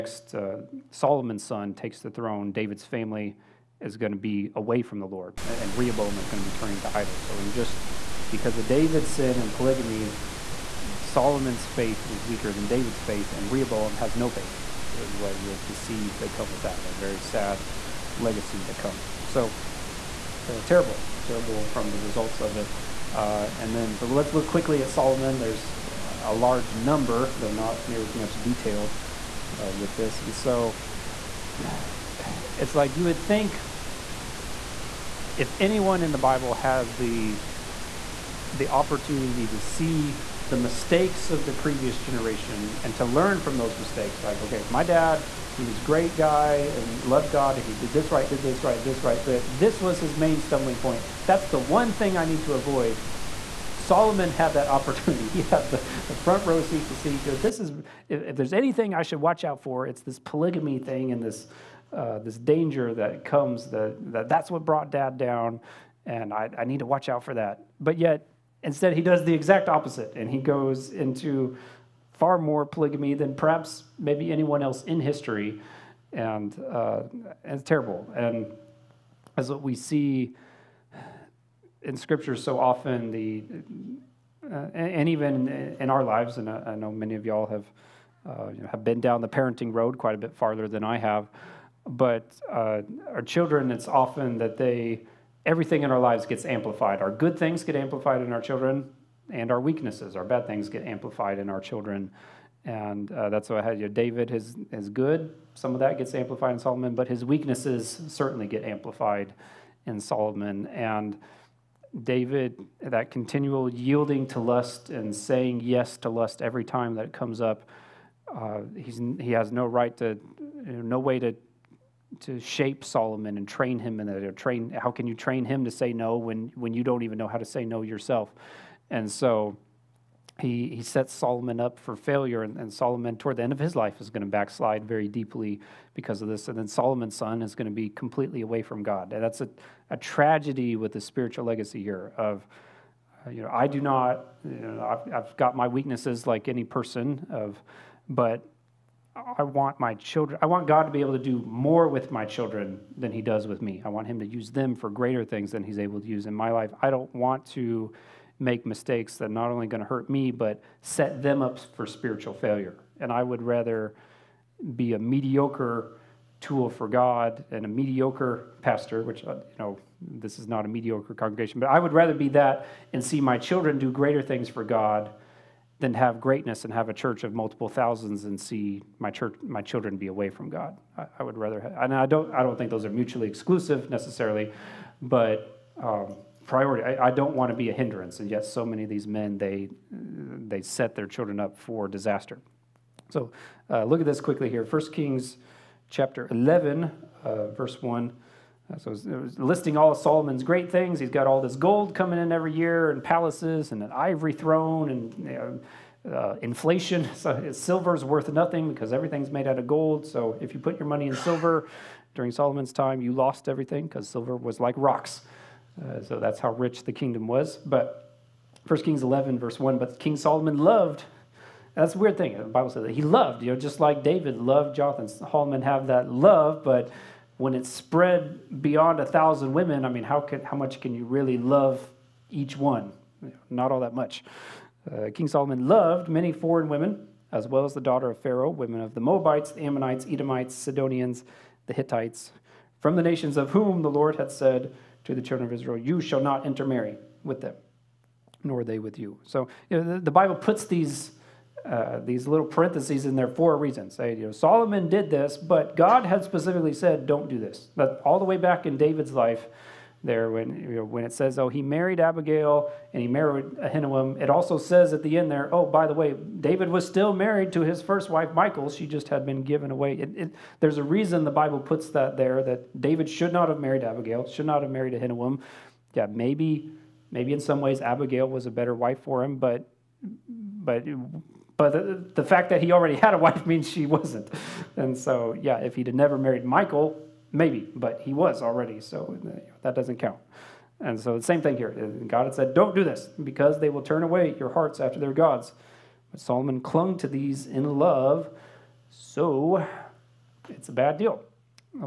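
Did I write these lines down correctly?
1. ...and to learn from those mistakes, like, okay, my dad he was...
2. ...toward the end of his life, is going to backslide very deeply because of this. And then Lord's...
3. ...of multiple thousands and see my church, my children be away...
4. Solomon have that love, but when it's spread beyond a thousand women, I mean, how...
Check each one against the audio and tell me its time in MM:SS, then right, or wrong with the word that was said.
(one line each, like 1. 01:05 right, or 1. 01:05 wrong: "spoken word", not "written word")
1. 00:42 right
2. 02:13 wrong: "Solomon", not "Lord"
3. 02:57 right
4. 03:45 right.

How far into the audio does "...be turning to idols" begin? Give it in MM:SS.
00:06.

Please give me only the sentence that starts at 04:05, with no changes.
You shall not intermarry with them, nor they with you.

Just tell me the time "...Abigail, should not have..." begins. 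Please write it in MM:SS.
04:33.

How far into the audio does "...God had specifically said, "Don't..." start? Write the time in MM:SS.
04:15.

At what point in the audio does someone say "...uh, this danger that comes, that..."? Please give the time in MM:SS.
01:01.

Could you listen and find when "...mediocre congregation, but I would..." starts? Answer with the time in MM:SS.
02:50.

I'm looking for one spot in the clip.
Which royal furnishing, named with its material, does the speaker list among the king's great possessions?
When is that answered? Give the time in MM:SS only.
03:23.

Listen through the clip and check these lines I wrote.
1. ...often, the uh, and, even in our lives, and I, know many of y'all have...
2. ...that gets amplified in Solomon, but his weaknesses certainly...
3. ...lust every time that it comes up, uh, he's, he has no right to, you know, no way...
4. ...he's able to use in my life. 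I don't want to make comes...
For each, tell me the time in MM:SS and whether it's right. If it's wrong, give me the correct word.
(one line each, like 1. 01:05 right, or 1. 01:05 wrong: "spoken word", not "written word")
1. 01:22 right
2. 01:45 right
3. 01:56 right
4. 02:35 wrong: "mistakes", not "comes".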